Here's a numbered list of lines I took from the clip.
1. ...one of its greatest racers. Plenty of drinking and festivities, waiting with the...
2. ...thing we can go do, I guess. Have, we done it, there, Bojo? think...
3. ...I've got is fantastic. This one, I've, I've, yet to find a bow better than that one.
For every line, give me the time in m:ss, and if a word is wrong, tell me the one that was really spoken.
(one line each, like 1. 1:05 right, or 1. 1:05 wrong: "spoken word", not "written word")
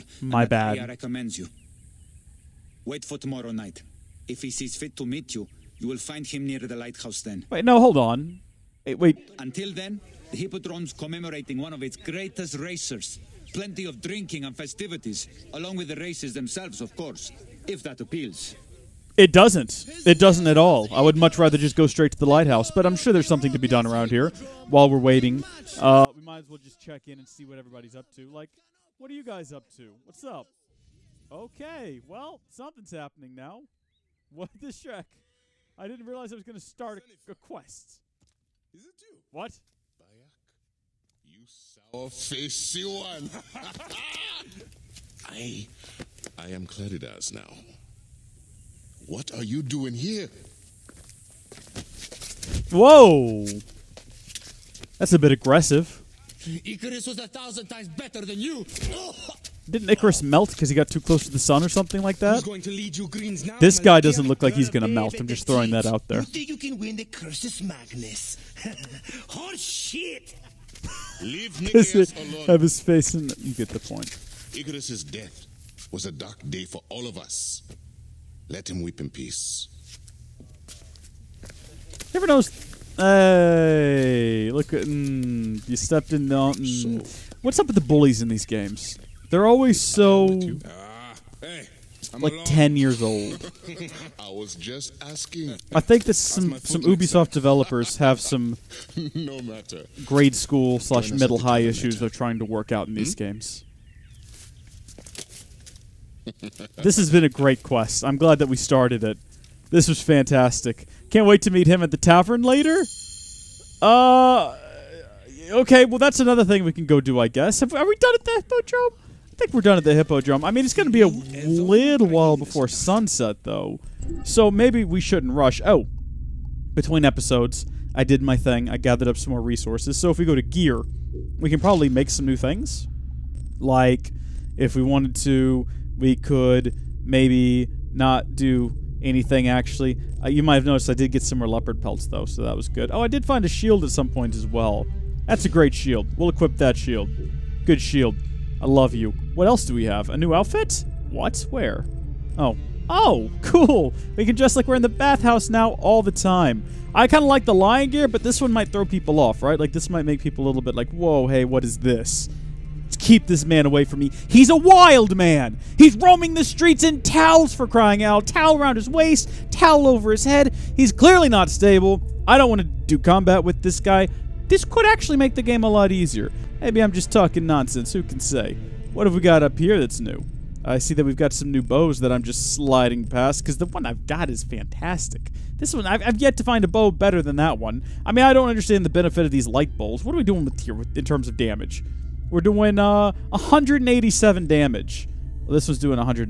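1. 0:11 wrong: "along", not "waiting"
2. 1:56 right
3. 3:03 right.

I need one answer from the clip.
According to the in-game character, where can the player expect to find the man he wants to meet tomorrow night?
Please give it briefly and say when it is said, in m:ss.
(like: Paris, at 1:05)
near the lighthouse, at 0:06.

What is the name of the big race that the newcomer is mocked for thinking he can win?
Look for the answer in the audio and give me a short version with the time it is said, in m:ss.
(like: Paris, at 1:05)
Cursus Magnus, at 1:07.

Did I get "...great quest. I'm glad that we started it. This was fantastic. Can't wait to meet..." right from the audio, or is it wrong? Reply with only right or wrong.
right.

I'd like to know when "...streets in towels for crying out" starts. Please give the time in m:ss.
2:46.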